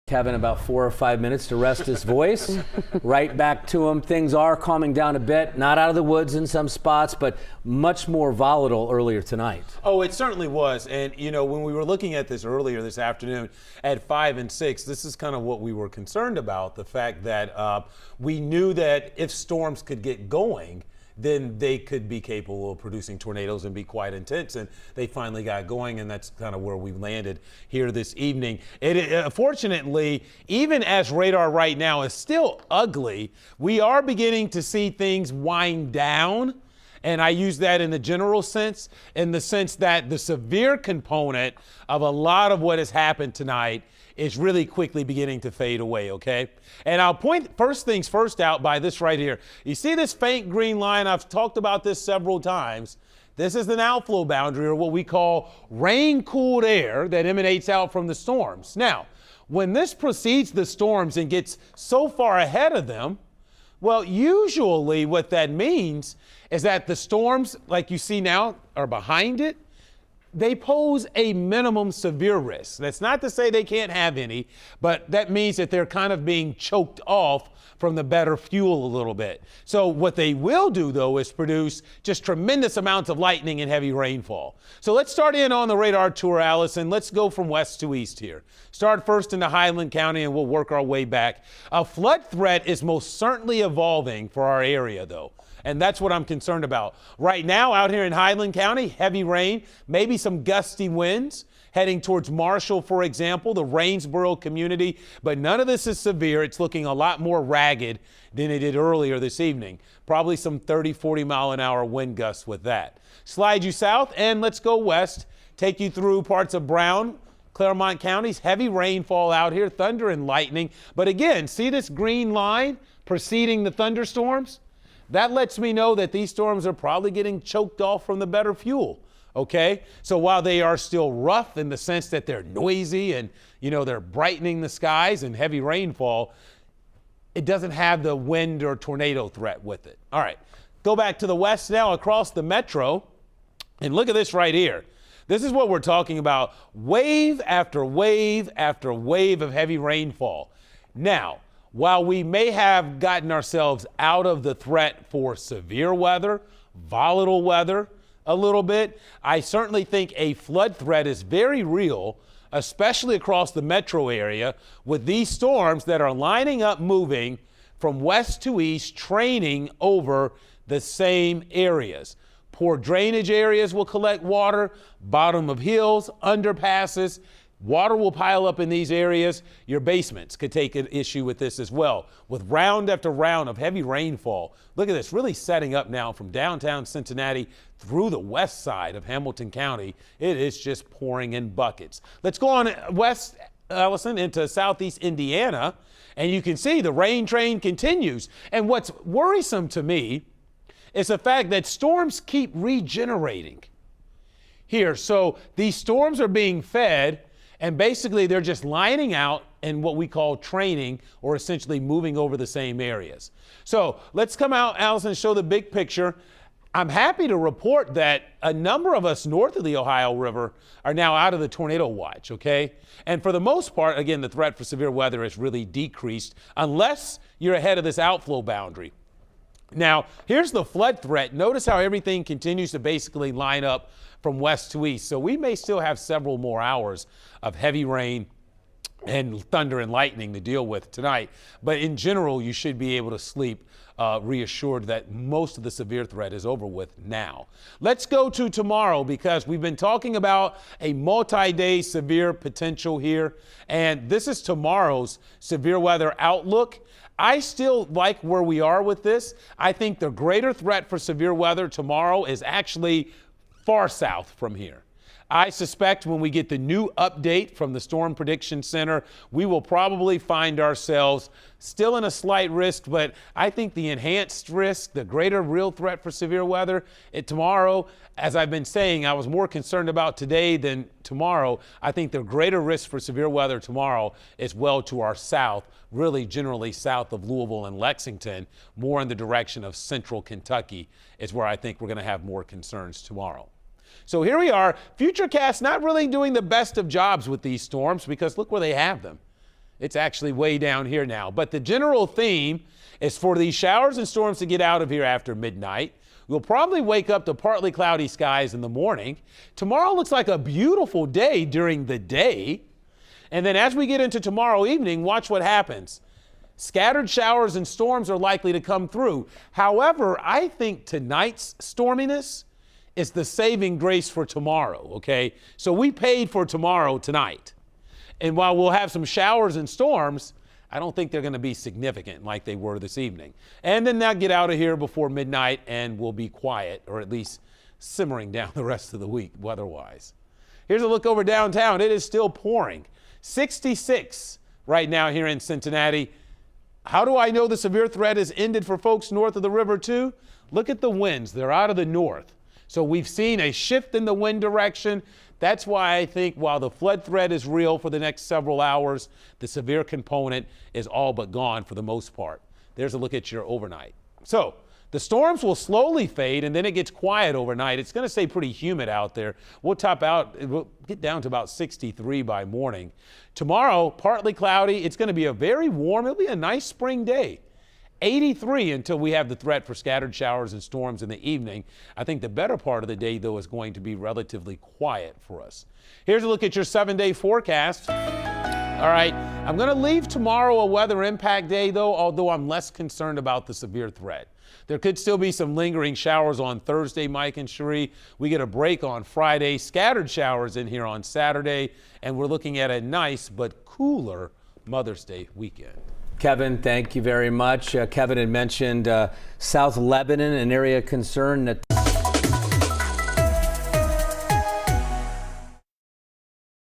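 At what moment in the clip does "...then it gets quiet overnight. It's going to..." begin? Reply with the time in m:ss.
6:06.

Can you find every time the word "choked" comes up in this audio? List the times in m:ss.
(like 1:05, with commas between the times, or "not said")
1:16, 2:07.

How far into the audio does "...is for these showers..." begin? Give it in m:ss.
5:02.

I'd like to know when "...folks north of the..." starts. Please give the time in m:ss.
5:48.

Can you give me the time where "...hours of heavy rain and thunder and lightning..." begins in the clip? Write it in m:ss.
3:56.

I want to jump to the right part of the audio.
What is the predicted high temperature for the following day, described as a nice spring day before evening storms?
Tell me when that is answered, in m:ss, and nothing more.
6:18.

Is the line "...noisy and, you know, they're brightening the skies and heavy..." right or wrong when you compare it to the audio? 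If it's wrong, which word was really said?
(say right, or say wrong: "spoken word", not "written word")
right.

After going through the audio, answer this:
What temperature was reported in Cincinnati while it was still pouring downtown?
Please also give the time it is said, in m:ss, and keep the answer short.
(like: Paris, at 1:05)
66, at 5:43.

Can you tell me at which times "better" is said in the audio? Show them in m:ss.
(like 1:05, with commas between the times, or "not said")
1:18, 2:08, 6:22.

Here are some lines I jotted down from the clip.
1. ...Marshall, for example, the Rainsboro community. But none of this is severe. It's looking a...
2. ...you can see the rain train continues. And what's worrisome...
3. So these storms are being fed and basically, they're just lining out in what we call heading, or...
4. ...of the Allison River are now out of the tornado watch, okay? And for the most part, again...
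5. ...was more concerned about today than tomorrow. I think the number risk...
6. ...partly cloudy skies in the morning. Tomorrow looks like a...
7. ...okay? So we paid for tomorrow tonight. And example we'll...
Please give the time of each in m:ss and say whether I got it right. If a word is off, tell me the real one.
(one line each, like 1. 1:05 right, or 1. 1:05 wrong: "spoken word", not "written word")
1. 1:42 right
2. 3:16 right
3. 3:24 wrong: "training", not "heading"
4. 3:39 wrong: "Ohio", not "Allison"
5. 4:39 wrong: "greater", not "number"
6. 5:07 right
7. 5:24 wrong: "while", not "example".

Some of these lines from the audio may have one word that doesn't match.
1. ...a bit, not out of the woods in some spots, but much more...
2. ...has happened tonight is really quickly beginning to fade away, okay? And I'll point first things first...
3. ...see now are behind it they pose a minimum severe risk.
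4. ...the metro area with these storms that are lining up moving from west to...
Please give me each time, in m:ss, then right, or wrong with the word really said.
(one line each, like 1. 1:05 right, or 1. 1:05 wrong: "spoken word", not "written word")
1. 0:05 right
2. 0:42 right
3. 1:07 right
4. 2:43 right.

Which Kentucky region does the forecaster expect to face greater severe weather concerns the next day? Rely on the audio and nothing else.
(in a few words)
Central Kentucky.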